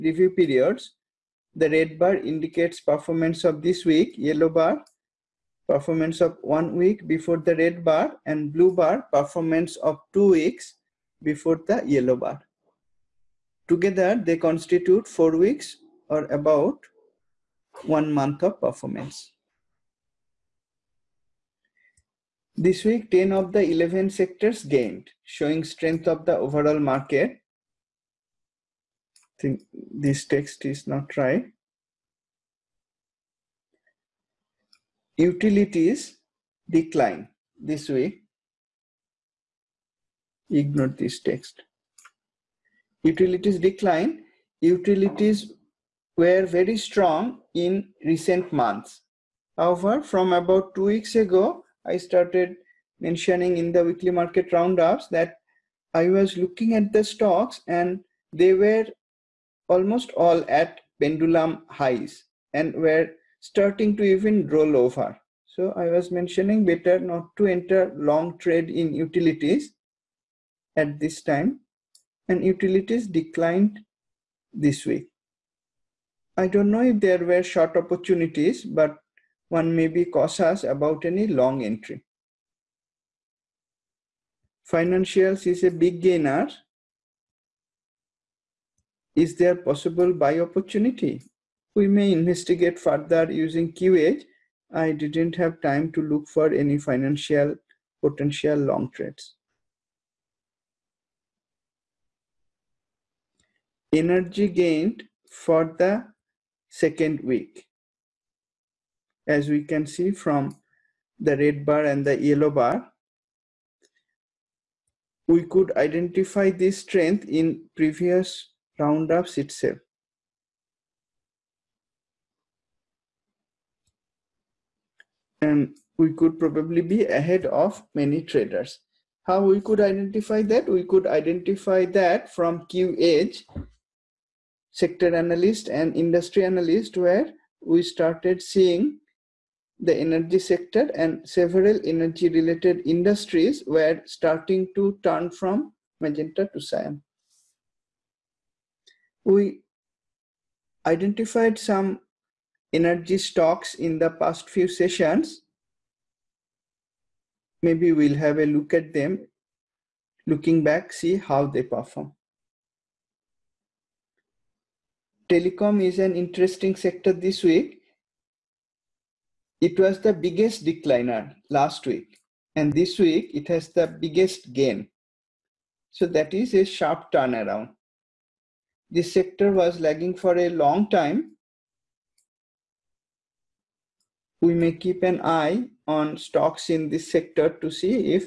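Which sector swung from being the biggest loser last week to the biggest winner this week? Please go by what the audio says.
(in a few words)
Telecom.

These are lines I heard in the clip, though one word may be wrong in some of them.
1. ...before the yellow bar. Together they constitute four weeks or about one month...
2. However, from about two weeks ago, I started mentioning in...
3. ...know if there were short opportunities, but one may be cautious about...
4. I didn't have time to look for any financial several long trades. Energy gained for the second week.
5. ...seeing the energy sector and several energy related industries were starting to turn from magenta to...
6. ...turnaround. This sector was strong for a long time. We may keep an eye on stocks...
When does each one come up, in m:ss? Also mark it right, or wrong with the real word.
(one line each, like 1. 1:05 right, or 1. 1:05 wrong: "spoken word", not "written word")
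1. 0:11 right
2. 0:49 right
3. 1:16 right
4. 1:34 wrong: "potential", not "several"
5. 2:18 right
6. 2:57 wrong: "lagging", not "strong".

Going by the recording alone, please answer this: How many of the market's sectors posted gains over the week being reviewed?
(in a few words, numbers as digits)
10.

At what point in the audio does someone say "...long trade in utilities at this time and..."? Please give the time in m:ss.
1:07.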